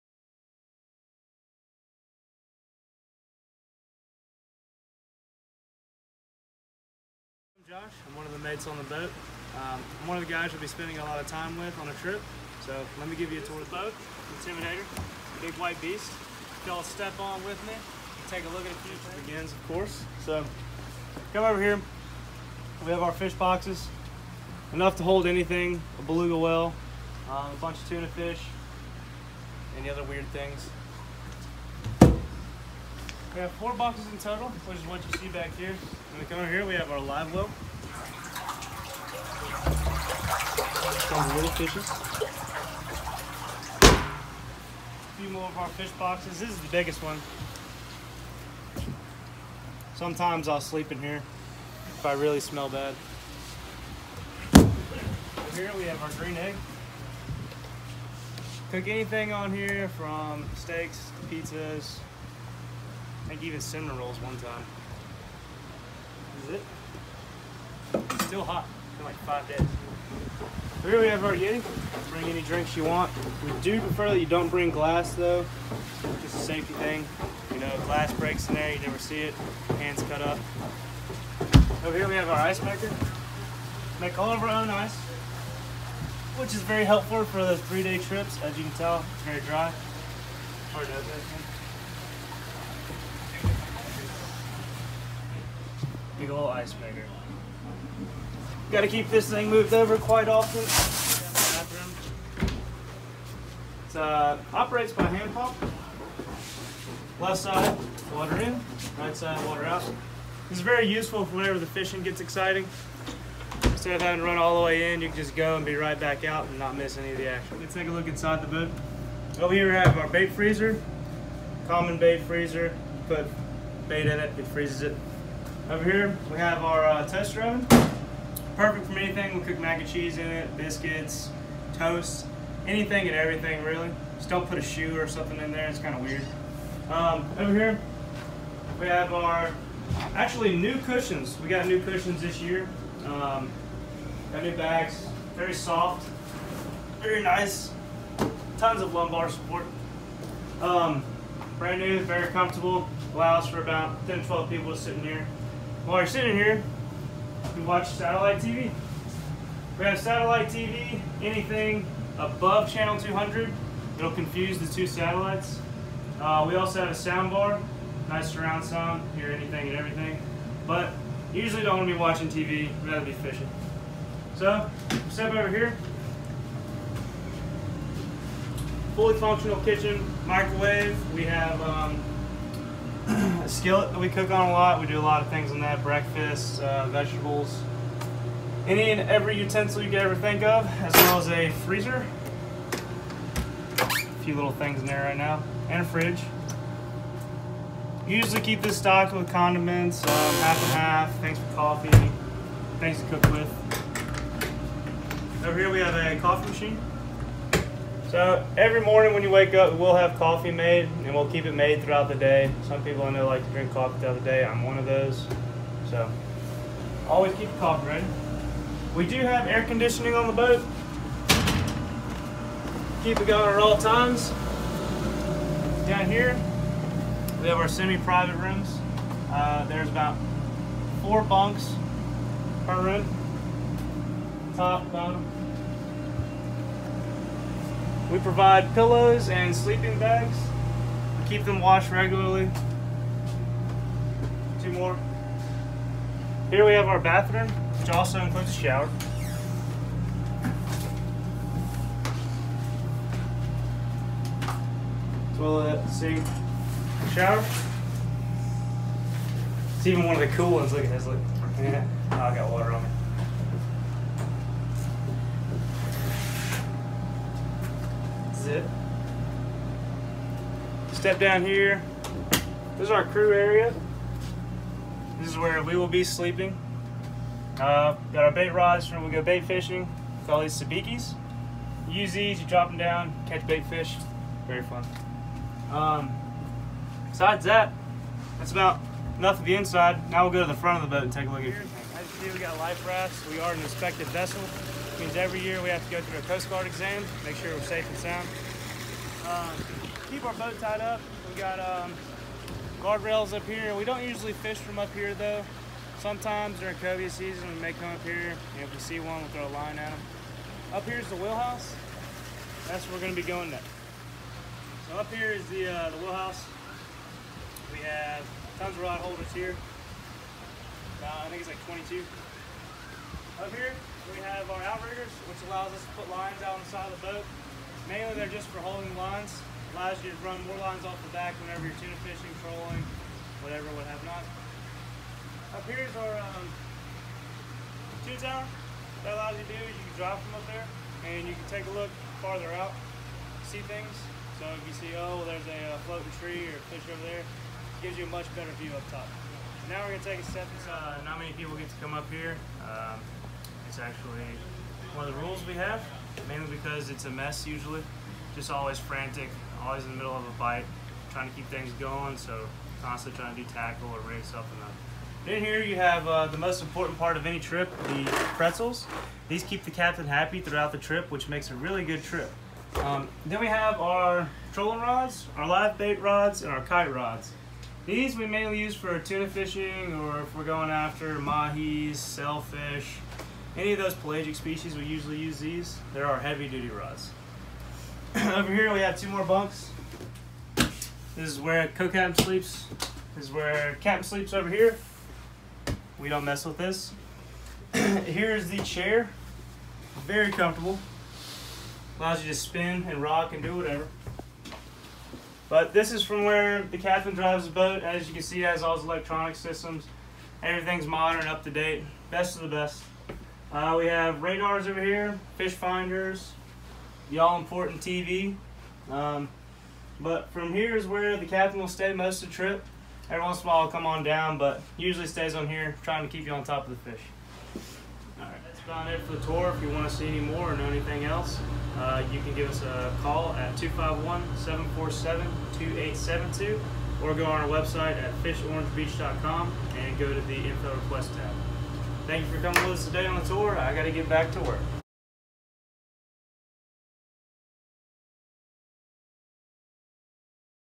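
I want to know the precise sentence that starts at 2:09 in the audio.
We'll cook mac and cheese in it, biscuits, toast, anything and everything, really.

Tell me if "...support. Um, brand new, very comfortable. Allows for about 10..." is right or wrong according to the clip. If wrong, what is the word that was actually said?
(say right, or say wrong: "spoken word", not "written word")
right.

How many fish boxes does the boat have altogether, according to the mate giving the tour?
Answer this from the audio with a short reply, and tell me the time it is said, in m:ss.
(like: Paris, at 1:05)
4, at 0:33.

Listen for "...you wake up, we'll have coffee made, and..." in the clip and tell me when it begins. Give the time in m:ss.
3:29.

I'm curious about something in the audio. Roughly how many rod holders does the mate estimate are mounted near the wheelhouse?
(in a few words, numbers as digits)
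22.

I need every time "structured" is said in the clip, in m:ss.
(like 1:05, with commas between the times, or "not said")
not said.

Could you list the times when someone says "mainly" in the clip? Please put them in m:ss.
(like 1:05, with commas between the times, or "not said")
5:27, 5:56, 6:18.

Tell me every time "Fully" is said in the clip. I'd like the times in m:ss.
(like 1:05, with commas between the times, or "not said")
2:58.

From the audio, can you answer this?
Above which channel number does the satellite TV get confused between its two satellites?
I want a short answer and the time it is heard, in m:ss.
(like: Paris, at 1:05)
200, at 2:42.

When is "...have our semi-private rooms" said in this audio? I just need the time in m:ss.
3:47.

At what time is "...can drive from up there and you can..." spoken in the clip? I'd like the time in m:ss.
5:39.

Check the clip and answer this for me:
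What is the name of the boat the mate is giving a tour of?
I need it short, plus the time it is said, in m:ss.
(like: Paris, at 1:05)
Intimidator, at 0:14.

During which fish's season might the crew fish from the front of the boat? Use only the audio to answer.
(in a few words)
cobia.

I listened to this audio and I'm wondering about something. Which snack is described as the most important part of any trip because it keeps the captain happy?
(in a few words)
pretzels.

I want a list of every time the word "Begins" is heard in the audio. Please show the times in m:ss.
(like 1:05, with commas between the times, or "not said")
0:19.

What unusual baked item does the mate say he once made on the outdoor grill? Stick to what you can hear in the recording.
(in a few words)
cinnamon rolls.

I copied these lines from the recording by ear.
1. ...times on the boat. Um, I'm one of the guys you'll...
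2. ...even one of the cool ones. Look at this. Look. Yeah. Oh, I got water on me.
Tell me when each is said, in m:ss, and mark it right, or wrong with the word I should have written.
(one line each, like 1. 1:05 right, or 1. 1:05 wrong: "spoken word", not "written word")
1. 0:08 wrong: "mates", not "times"
2. 4:19 right.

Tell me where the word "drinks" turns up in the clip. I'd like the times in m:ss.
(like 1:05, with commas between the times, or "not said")
1:12, 3:33.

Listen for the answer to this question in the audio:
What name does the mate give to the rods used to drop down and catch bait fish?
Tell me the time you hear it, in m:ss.
4:40.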